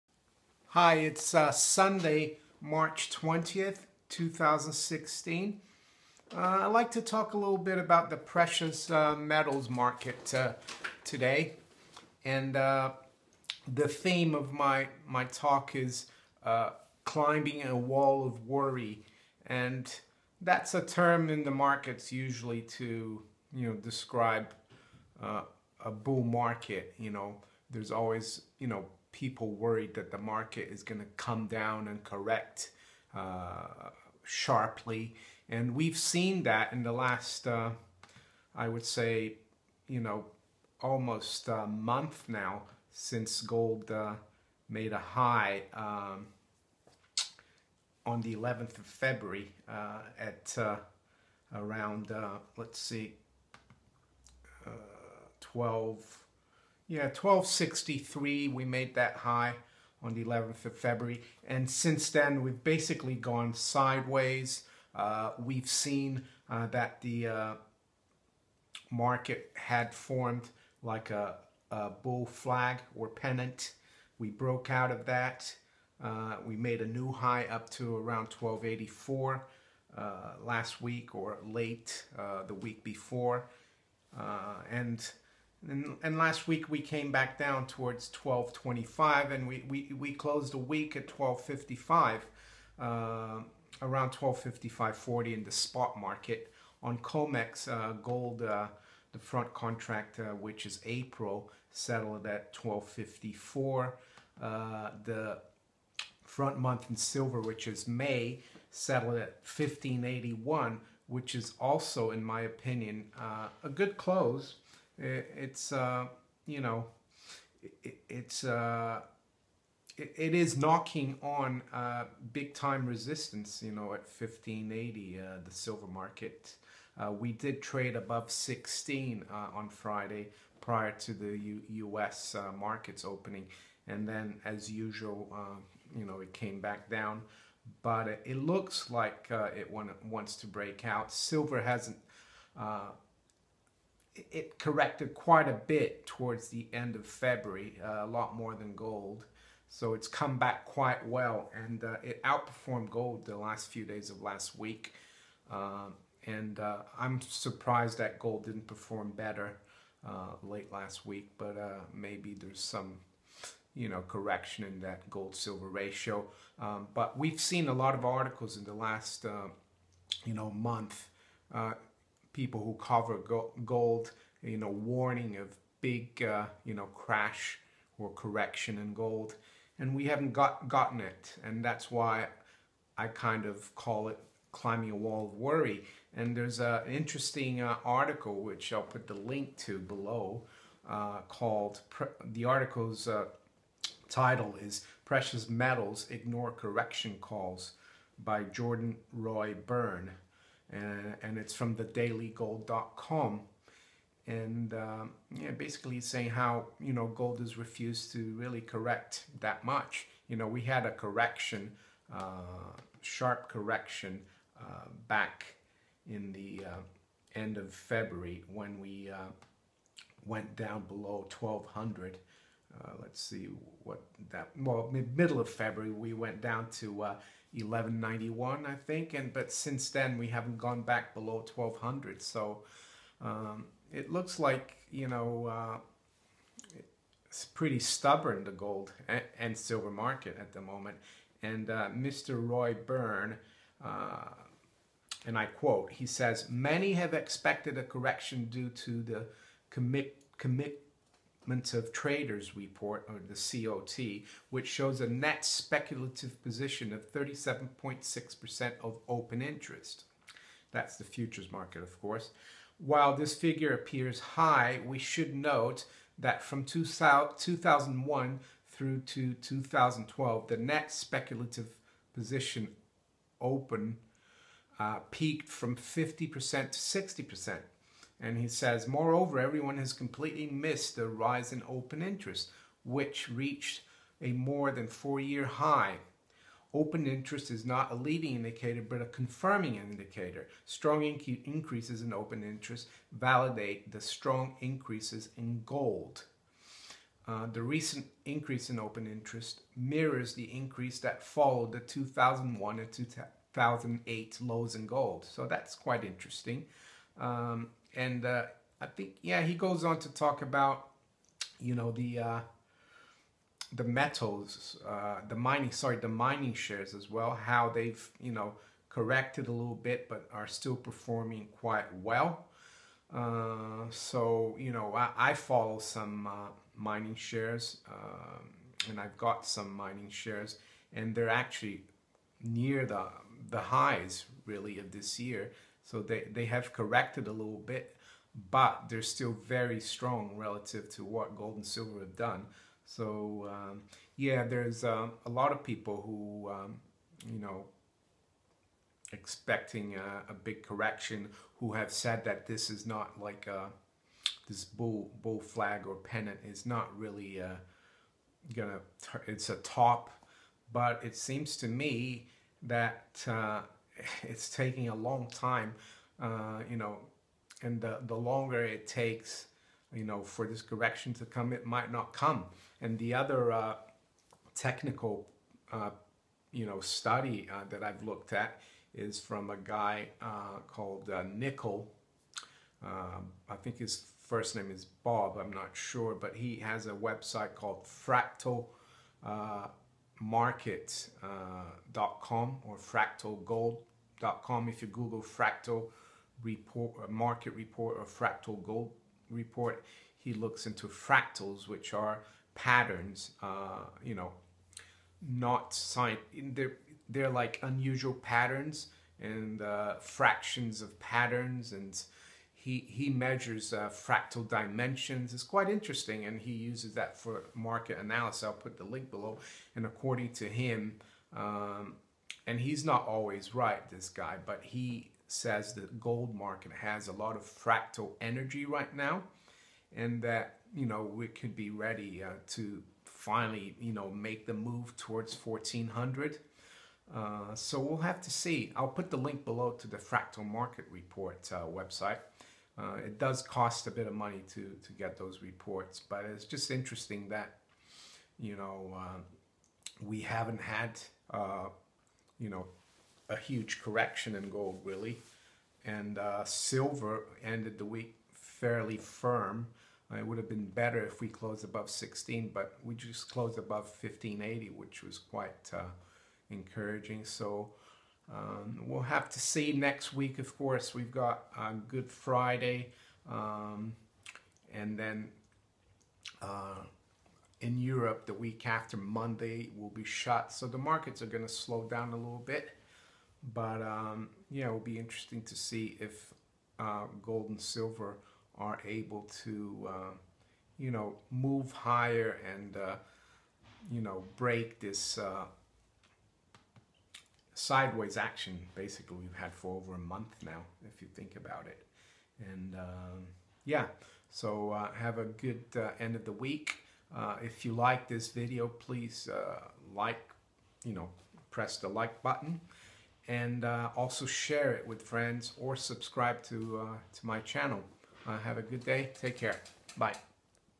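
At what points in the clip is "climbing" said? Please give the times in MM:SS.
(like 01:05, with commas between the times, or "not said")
00:17, 03:04.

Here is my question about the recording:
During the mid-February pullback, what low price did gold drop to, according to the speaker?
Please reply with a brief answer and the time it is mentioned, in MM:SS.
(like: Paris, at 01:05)
1191, at 03:47.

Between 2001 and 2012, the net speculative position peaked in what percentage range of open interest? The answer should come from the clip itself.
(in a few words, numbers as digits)
50% to 60%.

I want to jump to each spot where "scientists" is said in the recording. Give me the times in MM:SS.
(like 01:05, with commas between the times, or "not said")
not said.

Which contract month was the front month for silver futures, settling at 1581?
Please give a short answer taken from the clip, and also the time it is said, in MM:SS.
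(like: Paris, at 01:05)
May, at 01:47.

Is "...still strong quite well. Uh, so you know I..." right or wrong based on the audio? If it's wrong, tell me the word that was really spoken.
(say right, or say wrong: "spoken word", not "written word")
wrong: "performing", not "strong".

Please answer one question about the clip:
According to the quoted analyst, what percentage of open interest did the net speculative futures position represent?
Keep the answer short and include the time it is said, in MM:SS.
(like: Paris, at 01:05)
37.6%, at 04:17.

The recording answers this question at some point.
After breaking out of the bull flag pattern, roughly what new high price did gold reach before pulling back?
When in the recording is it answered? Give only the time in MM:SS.
01:18.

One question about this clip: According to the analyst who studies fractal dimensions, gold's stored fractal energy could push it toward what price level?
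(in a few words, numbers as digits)
1400.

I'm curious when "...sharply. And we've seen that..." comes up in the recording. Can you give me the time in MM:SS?
00:34.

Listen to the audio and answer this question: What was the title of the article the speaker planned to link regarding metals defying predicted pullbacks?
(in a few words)
Precious Metals Ignore Correction Calls.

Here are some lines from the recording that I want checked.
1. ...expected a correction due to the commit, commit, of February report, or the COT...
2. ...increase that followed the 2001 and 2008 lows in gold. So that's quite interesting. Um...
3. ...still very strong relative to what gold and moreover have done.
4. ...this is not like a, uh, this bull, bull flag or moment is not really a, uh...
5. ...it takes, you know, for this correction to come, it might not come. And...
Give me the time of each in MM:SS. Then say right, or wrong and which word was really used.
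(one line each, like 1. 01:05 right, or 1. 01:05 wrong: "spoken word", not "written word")
1. 04:07 wrong: "Traders", not "February"
2. 05:00 right
3. 05:39 wrong: "silver", not "moreover"
4. 05:52 wrong: "pennant", not "moment"
5. 06:08 right.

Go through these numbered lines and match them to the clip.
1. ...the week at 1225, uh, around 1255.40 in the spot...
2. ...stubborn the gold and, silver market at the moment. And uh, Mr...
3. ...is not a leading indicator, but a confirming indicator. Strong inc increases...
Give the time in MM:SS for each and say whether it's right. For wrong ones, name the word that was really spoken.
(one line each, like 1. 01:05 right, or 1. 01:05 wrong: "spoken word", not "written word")
1. 01:30 wrong: "1255", not "1225"
2. 03:57 right
3. 04:47 right.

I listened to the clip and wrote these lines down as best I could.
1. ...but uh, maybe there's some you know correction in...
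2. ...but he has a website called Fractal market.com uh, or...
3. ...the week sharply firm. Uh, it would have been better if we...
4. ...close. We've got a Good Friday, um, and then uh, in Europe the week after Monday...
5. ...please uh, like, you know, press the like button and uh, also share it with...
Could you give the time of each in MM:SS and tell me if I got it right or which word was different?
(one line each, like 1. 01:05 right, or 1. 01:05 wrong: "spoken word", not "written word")
1. 02:41 right
2. 06:26 right
3. 07:37 wrong: "fairly", not "sharply"
4. 07:50 wrong: "course", not "close"
5. 08:28 right.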